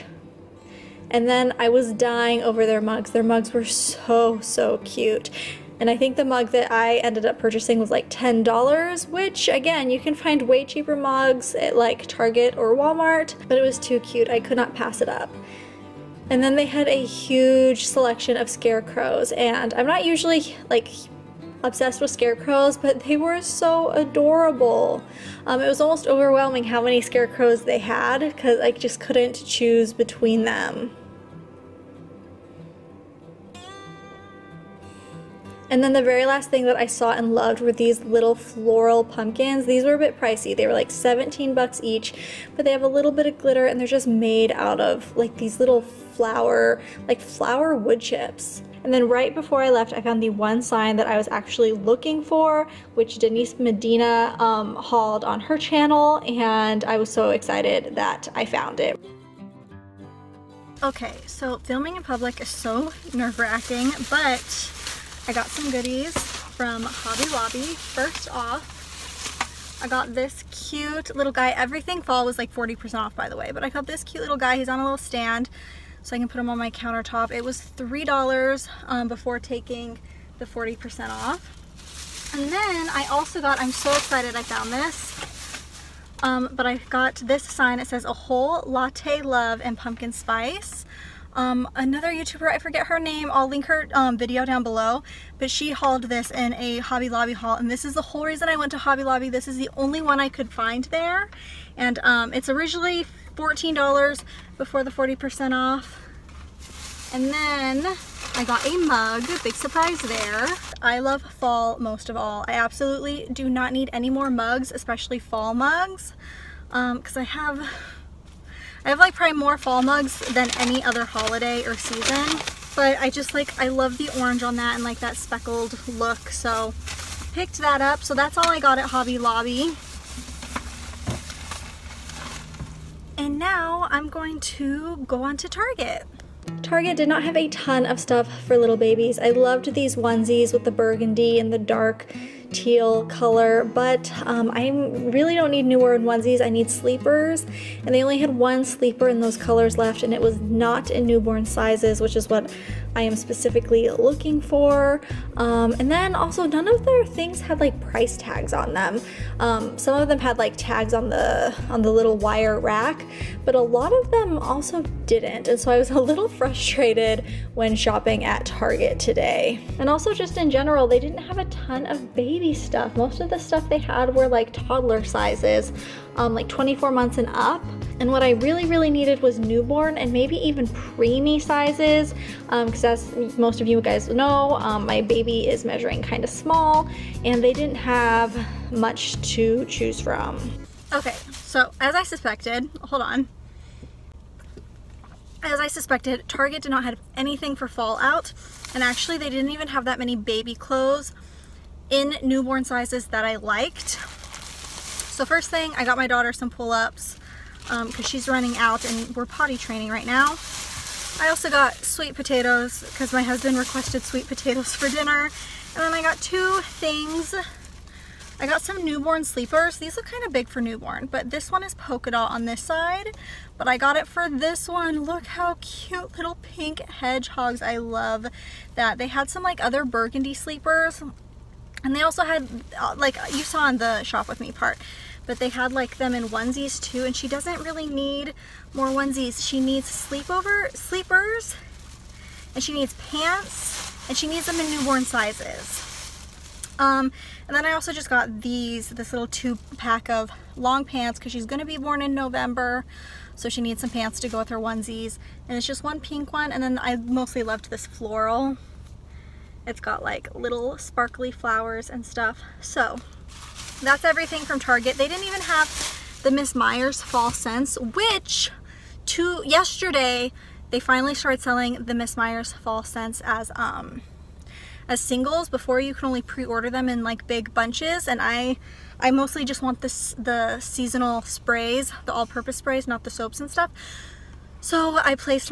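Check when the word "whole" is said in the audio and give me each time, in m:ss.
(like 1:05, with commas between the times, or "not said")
1:28, 1:38.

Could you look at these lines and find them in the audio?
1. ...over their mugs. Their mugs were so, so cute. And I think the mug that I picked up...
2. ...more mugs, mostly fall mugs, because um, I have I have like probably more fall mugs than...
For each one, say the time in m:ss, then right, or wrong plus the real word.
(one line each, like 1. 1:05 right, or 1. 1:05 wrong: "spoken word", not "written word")
1. 0:02 wrong: "ended", not "picked"
2. 1:54 wrong: "especially", not "mostly".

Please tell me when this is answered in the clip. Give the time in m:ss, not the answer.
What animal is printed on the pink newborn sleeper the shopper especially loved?
3:46.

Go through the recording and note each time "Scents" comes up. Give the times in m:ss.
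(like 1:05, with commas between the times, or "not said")
4:27, 4:32.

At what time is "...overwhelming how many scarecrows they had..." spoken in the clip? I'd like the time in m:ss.
0:26.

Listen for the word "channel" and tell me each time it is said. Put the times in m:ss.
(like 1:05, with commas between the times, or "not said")
0:55.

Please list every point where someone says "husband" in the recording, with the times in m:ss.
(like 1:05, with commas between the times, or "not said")
3:33.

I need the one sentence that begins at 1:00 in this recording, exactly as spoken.
Okay, so filming in public is so nerve-wracking, but I got some goodies from Hobby Lobby.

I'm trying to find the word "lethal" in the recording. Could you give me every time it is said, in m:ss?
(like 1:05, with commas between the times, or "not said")
not said.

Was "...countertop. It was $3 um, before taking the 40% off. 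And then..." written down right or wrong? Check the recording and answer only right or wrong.
right.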